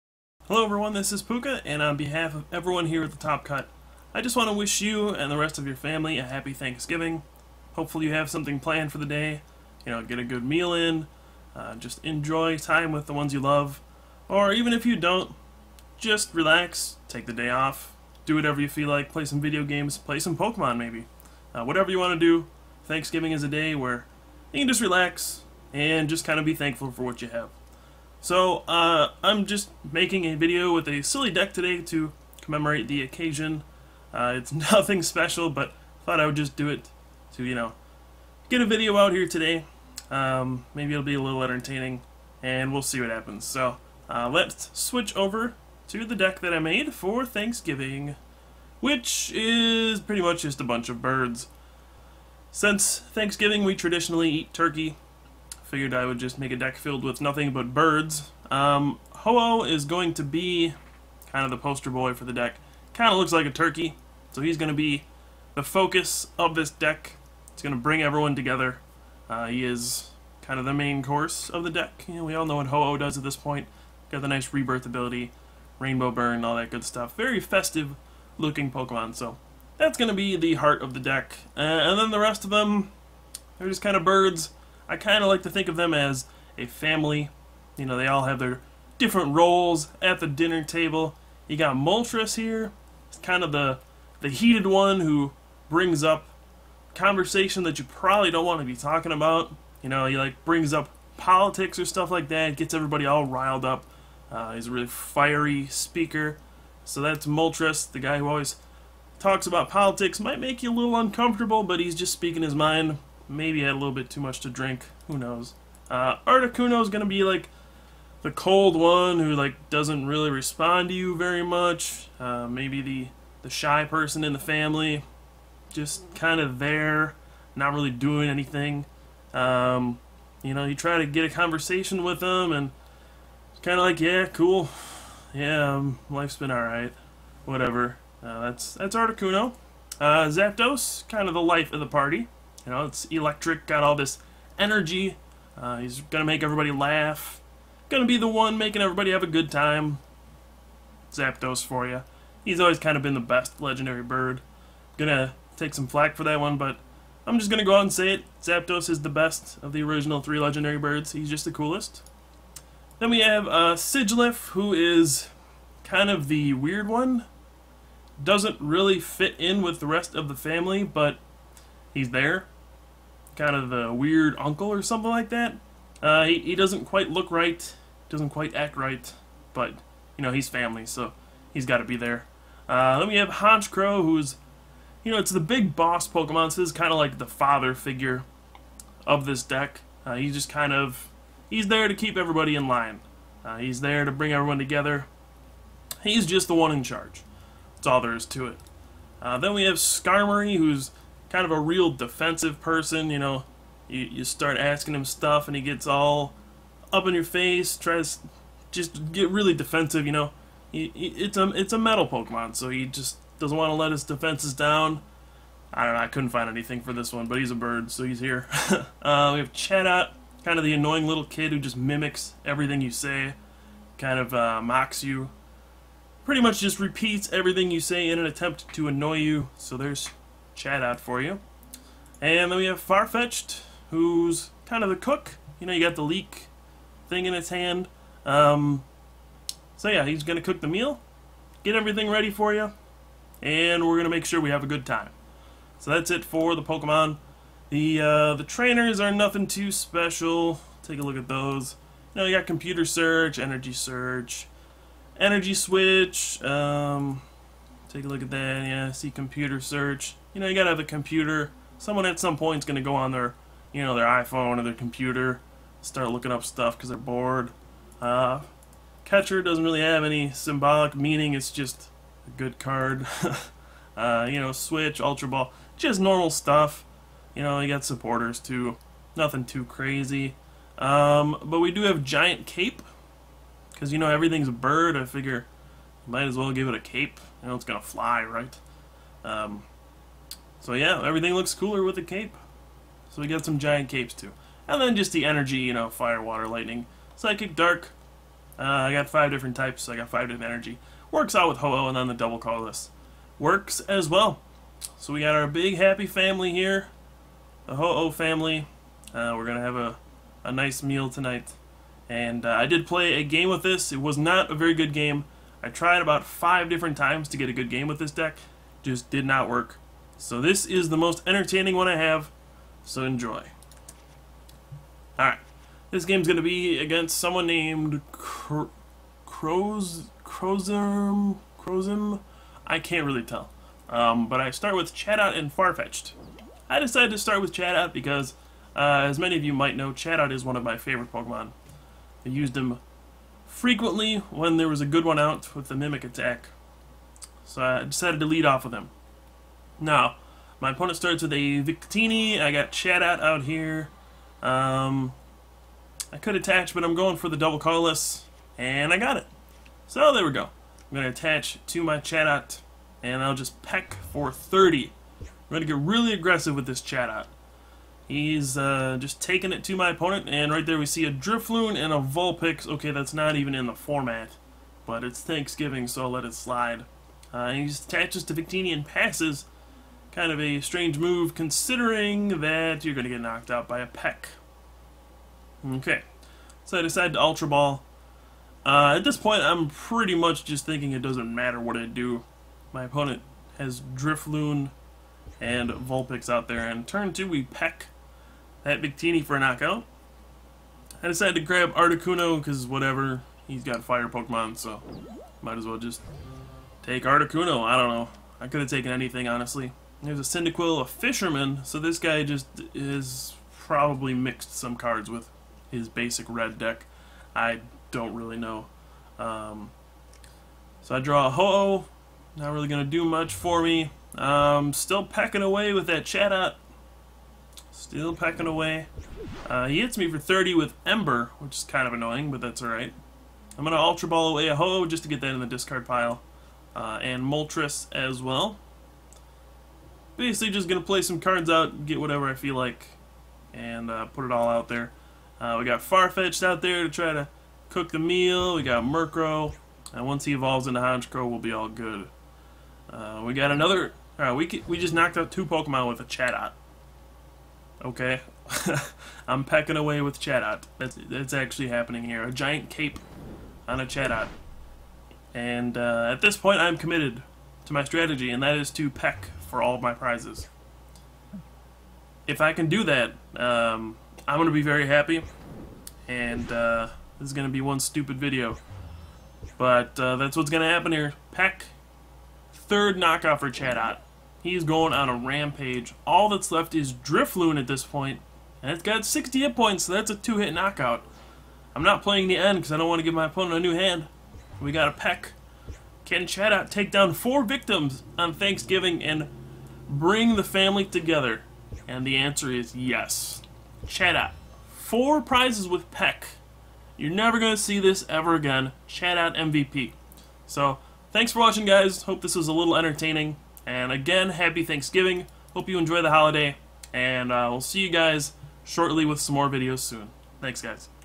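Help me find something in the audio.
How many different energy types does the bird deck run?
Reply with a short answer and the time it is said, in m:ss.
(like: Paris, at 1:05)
5, at 4:59.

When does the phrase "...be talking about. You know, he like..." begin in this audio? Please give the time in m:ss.
1:38.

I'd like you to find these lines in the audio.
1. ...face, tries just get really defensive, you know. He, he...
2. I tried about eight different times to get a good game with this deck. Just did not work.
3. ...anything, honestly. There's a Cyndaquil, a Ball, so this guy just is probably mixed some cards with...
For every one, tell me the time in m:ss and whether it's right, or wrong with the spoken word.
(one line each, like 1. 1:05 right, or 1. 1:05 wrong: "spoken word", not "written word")
1. 3:27 right
2. 5:15 wrong: "five", not "eight"
3. 6:48 wrong: "Fisherman", not "Ball".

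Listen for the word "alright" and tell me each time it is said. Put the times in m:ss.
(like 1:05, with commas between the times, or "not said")
5:25, 7:12.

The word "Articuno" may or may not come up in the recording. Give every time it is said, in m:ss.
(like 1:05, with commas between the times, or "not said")
2:18, 6:41, 6:47.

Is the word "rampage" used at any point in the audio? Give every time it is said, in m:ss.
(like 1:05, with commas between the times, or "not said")
8:05.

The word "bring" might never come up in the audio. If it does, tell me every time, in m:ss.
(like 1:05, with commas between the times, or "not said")
1:07, 1:35, 1:40, 3:14, 8:19.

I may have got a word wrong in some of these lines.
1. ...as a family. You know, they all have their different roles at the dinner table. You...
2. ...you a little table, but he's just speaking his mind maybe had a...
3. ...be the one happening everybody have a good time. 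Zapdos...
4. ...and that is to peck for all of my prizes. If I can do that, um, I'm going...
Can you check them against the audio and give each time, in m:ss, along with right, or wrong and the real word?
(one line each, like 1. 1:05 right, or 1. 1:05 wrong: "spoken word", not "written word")
1. 1:25 right
2. 1:50 wrong: "uncomfortable", not "table"
3. 2:28 wrong: "making", not "happening"
4. 7:48 right.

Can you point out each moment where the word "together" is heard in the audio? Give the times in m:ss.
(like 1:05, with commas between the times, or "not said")
1:08, 3:14, 8:20.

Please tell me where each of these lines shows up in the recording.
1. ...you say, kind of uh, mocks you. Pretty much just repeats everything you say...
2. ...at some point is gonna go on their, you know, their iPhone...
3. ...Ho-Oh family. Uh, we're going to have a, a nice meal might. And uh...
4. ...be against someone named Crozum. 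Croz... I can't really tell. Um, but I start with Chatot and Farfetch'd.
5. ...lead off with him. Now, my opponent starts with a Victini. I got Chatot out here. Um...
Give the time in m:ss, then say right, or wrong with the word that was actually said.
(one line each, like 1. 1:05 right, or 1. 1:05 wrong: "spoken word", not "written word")
1. 3:42 right
2. 4:22 right
3. 5:07 wrong: "tonight", not "might"
4. 5:26 right
5. 5:48 right.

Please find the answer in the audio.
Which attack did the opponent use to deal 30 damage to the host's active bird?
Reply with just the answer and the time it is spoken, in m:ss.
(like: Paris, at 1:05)
Ember, at 7:10.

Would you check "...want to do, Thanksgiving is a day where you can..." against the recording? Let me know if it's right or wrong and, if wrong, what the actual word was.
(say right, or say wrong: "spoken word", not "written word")
right.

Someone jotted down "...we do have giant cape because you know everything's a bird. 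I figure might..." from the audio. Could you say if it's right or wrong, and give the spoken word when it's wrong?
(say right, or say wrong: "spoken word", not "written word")
right.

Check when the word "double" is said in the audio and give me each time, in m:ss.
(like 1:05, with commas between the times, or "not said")
5:02, 5:57.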